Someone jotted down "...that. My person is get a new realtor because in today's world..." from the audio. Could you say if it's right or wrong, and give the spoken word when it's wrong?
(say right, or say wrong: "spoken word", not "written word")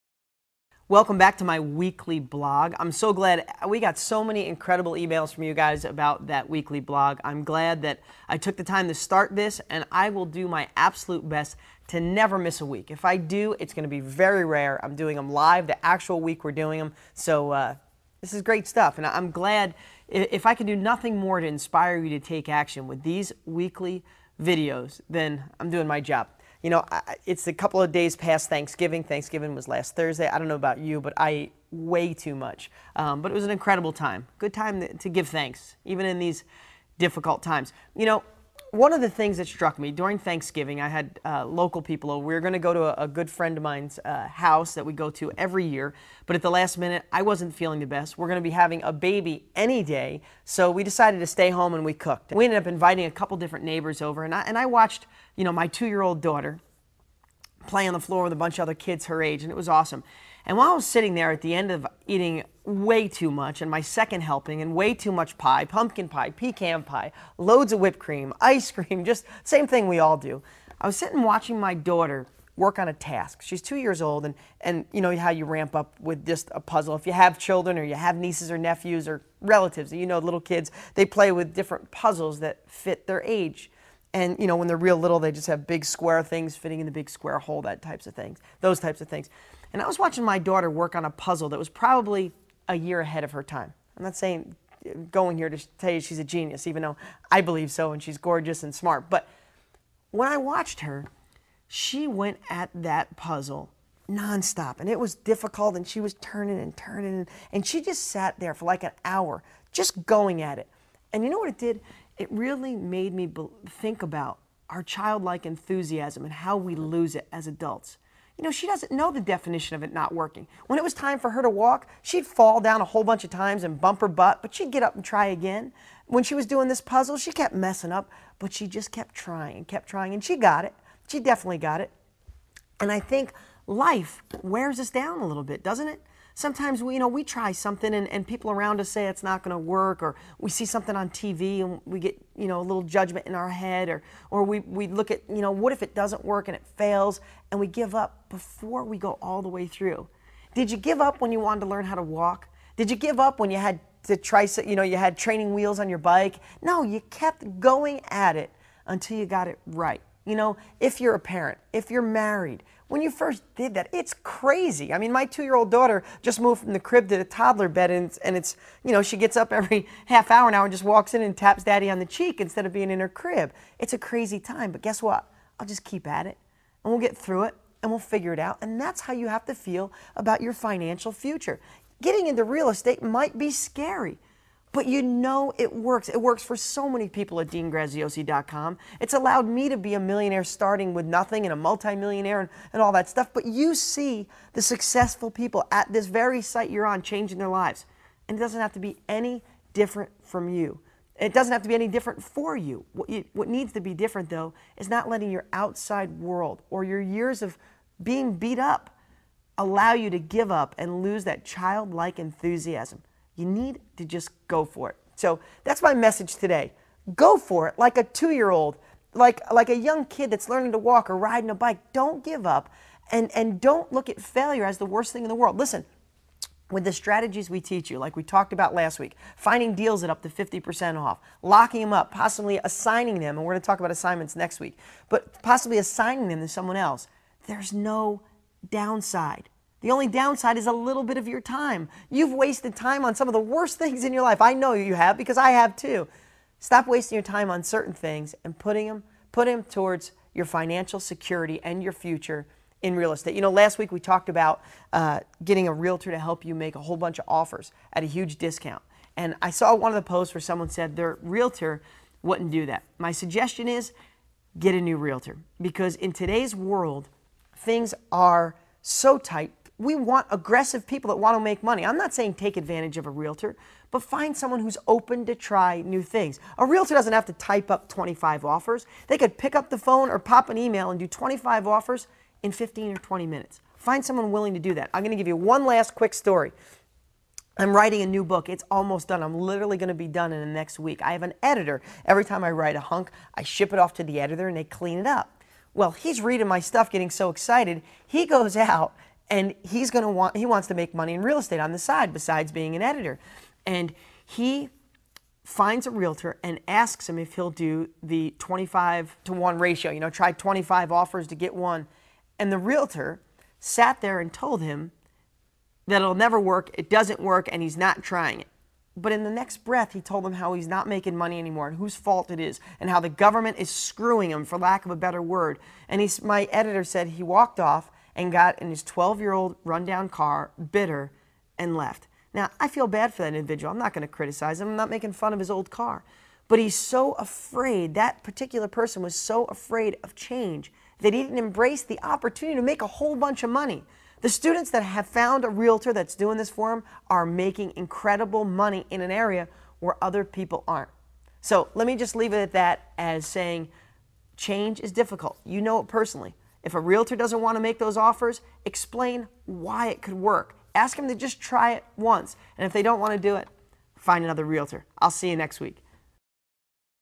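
wrong: "suggestion", not "person".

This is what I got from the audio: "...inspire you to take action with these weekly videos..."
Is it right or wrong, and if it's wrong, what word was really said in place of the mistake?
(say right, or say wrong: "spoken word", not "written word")
right.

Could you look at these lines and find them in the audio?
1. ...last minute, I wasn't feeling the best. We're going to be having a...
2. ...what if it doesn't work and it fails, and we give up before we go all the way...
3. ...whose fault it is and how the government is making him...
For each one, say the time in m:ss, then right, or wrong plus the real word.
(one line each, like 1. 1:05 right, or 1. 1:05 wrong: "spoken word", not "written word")
1. 0:46 right
2. 2:25 right
3. 5:21 wrong: "screwing", not "making".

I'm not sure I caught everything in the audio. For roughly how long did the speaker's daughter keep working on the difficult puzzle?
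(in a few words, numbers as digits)
An hour.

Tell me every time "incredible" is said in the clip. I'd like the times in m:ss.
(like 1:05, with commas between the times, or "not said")
0:04, 0:33, 5:47.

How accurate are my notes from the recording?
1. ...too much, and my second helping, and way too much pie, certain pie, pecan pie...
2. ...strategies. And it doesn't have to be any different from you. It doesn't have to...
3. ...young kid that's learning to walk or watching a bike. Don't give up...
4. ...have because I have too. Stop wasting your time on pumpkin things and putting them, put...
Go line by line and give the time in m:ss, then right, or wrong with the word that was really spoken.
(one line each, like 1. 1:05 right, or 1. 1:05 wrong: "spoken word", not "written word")
1. 1:03 wrong: "pumpkin", not "certain"
2. 3:17 wrong: "lives", not "strategies"
3. 3:39 wrong: "riding", not "watching"
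4. 4:04 wrong: "certain", not "pumpkin".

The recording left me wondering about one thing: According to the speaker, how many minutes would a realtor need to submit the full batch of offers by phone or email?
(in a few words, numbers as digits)
15 or 20 minutes.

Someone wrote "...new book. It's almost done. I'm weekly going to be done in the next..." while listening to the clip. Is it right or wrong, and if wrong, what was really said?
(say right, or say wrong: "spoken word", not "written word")
wrong: "literally", not "weekly".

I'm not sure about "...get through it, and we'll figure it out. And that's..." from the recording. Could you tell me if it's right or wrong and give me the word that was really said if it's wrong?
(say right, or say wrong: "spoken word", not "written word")
right.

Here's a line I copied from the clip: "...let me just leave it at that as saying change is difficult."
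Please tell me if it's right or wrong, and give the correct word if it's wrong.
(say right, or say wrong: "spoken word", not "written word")
right.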